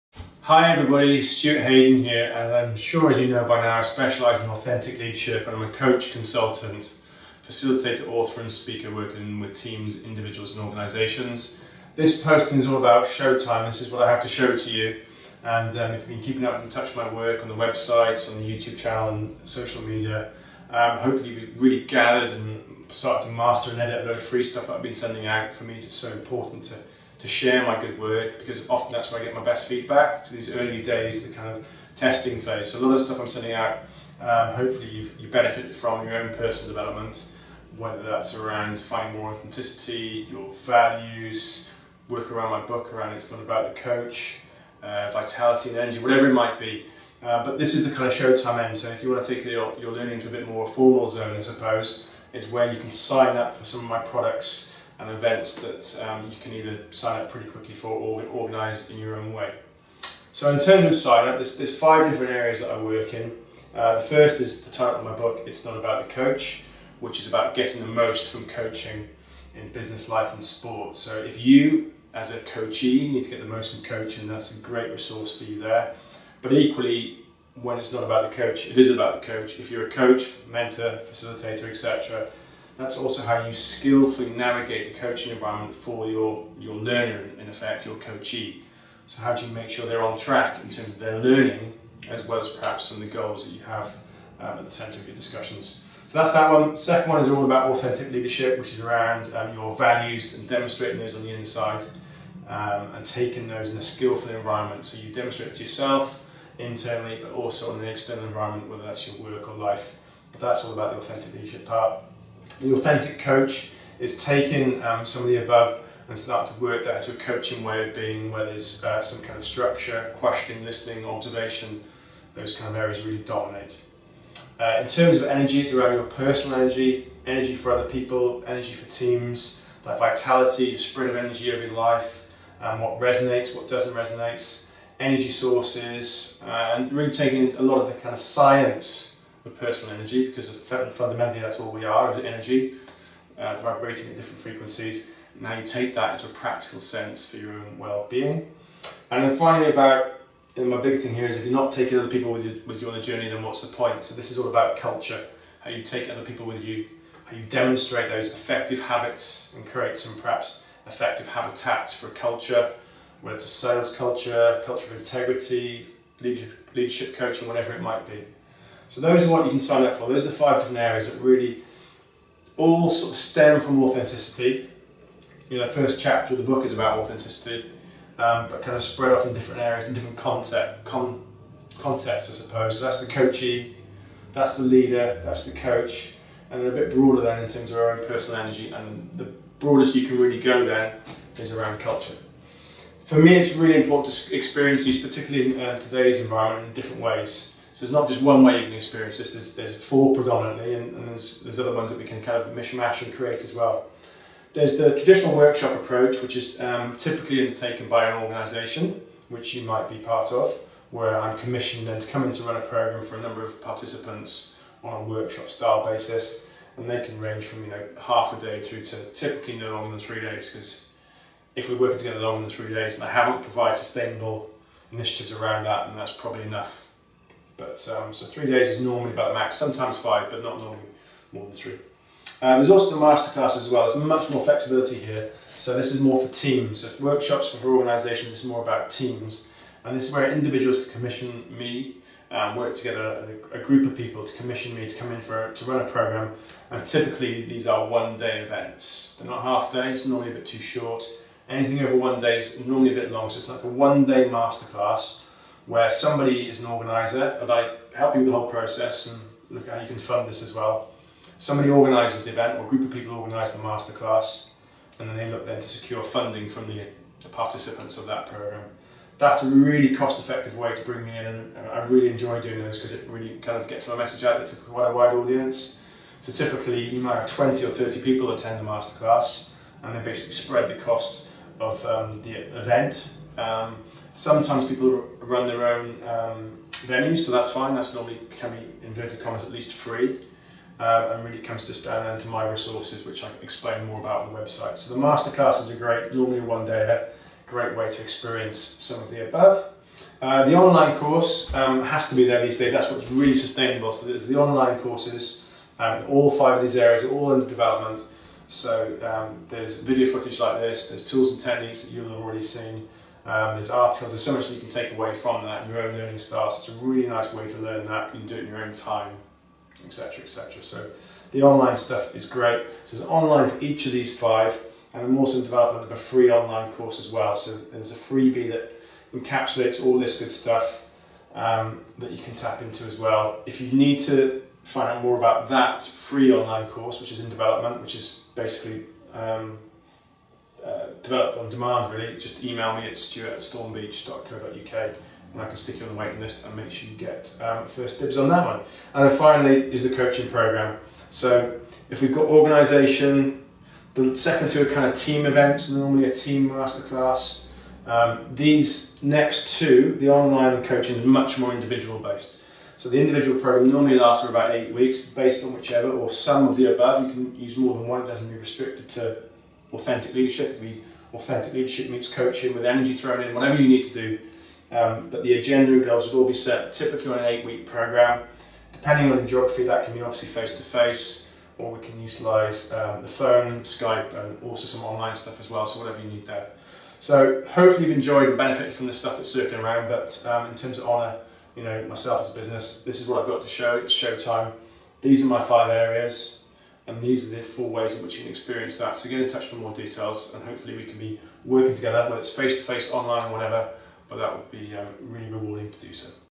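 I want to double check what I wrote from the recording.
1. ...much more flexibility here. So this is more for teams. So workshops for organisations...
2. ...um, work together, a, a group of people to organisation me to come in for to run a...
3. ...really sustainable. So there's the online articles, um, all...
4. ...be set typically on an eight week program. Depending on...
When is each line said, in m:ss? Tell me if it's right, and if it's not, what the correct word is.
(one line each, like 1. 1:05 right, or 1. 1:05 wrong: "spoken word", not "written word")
1. 3:54 right
2. 4:02 wrong: "commission", not "organisation"
3. 5:03 wrong: "courses", not "articles"
4. 6:16 right.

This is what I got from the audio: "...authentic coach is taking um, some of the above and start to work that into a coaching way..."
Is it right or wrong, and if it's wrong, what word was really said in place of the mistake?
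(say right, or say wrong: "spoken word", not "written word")
right.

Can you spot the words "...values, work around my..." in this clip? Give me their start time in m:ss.
0:40.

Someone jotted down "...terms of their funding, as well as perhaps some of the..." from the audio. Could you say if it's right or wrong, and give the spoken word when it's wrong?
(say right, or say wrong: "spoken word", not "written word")
wrong: "learning", not "funding".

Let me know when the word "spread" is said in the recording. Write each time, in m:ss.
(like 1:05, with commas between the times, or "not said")
2:10, 2:58, 4:40.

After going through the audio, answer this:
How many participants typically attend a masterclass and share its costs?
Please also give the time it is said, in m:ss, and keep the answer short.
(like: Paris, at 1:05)
20 or 30, at 4:37.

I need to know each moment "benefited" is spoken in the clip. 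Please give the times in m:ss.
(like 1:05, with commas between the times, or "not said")
0:35, 6:28.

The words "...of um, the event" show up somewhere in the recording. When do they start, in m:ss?
4:41.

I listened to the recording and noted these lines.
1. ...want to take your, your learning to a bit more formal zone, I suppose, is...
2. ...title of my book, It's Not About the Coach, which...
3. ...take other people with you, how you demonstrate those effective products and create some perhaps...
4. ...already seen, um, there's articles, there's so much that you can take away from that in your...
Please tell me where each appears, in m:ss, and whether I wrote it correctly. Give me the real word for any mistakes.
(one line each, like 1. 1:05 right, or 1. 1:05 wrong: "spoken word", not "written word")
1. 0:49 right
2. 1:04 right
3. 2:35 wrong: "habits", not "products"
4. 5:12 right.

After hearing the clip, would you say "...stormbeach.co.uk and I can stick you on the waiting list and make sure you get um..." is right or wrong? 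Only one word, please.
right.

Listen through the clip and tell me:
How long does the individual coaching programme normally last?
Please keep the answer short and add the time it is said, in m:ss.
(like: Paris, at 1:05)
8 weeks, at 6:04.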